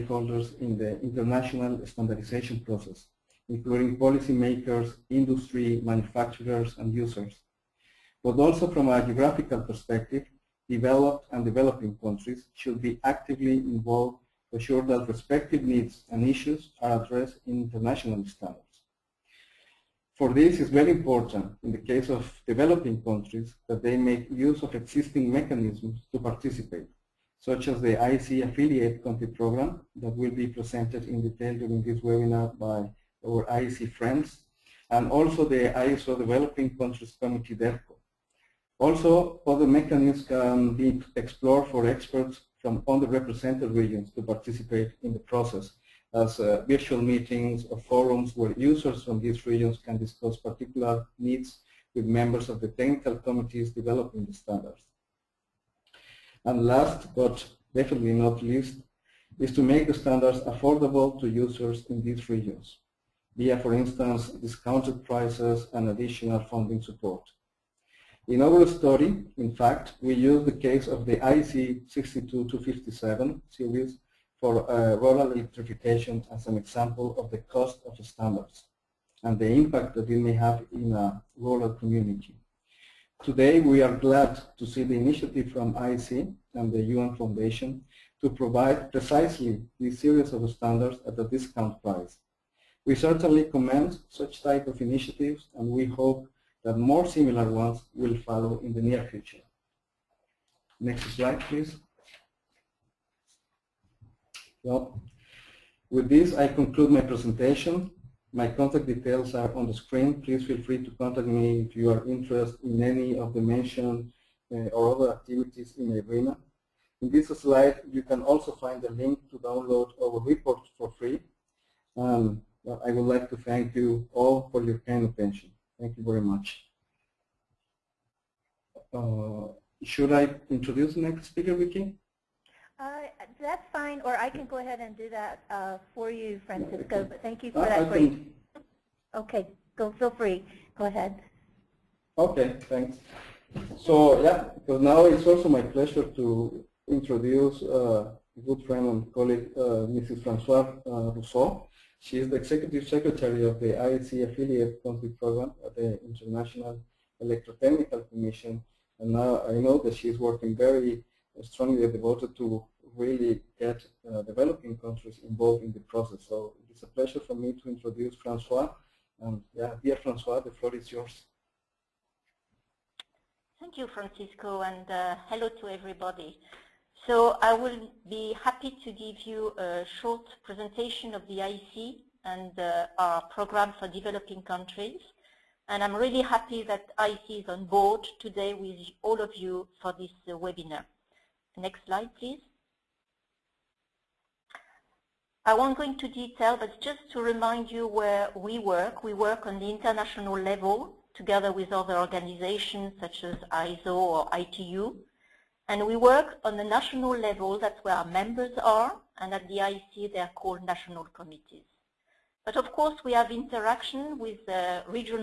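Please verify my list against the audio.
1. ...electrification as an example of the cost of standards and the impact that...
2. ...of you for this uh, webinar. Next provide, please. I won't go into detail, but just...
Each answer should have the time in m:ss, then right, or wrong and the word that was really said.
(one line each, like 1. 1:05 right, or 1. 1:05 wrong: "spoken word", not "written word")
1. 1:15 right
2. 3:09 wrong: "slide", not "provide".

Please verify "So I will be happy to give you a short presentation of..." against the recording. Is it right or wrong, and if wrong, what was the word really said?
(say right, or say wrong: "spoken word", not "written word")
right.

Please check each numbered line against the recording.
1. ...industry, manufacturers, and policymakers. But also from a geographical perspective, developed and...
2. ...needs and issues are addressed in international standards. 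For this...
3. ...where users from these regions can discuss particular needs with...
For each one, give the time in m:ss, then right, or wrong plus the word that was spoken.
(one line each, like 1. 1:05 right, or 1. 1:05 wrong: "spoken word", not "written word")
1. 0:05 wrong: "users", not "policymakers"
2. 0:15 right
3. 0:48 right.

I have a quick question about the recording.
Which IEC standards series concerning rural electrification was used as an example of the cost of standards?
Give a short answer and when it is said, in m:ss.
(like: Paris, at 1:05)
IEC 62257, at 1:11.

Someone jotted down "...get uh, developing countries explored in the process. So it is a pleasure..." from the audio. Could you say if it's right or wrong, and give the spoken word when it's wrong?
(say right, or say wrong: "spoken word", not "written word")
wrong: "involved", not "explored".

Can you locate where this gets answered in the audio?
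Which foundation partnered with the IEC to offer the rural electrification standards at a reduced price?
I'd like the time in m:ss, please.
1:26.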